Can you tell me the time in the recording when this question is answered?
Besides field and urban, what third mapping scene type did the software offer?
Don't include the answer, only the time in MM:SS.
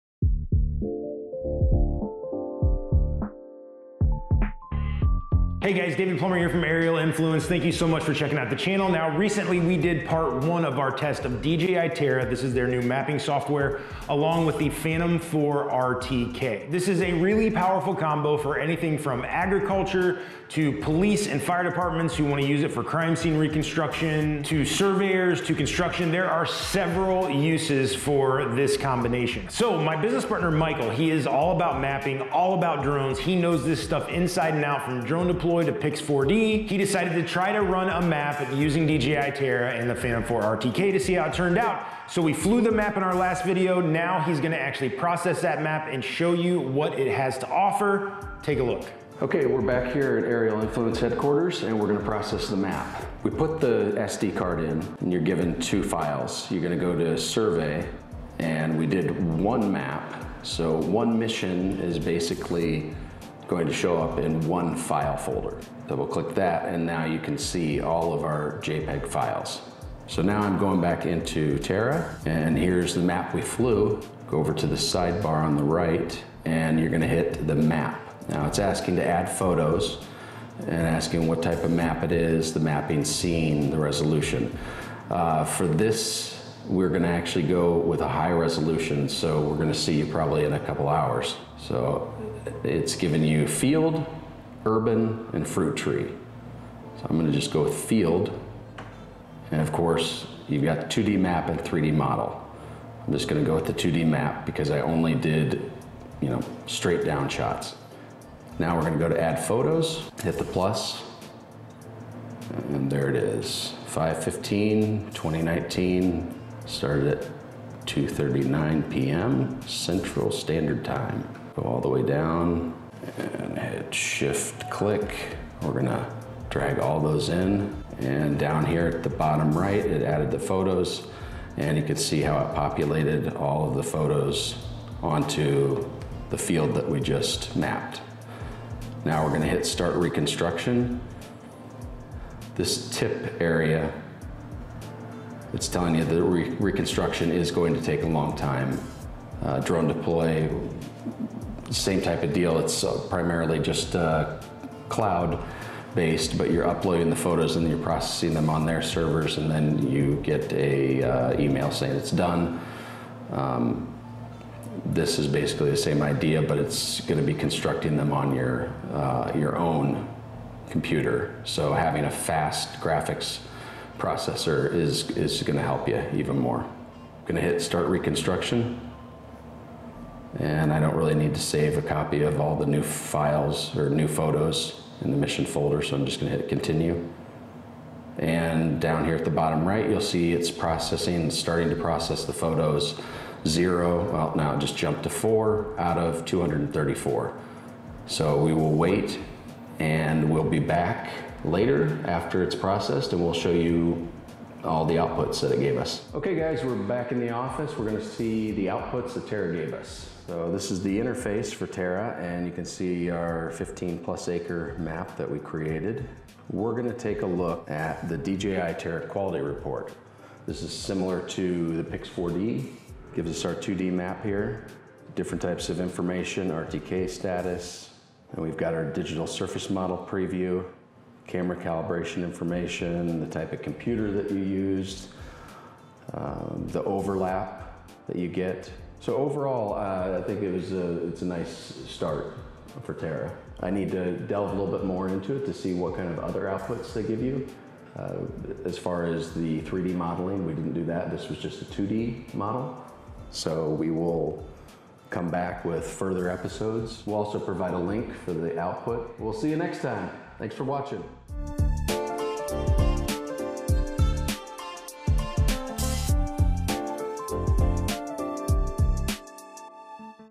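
01:35.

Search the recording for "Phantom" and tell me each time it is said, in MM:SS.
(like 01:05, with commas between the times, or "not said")
00:14, 00:39.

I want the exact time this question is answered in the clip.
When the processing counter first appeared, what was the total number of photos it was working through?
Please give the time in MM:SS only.
03:16.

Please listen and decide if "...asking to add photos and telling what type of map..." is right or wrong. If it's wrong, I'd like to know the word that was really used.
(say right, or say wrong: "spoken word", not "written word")
wrong: "asking", not "telling".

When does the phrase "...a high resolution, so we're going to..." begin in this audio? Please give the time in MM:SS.
01:28.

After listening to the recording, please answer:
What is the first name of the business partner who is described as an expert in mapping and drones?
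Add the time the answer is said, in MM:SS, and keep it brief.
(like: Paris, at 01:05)
Michael, at 00:30.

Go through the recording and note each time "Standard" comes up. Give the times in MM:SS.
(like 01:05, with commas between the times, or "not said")
02:00.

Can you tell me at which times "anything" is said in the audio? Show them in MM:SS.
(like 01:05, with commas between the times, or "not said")
00:18.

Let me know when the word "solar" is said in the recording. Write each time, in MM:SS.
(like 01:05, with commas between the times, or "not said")
not said.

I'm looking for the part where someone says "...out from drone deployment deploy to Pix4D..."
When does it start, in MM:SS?
00:34.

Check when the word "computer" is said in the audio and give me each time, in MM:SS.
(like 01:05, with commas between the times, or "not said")
02:50, 03:53.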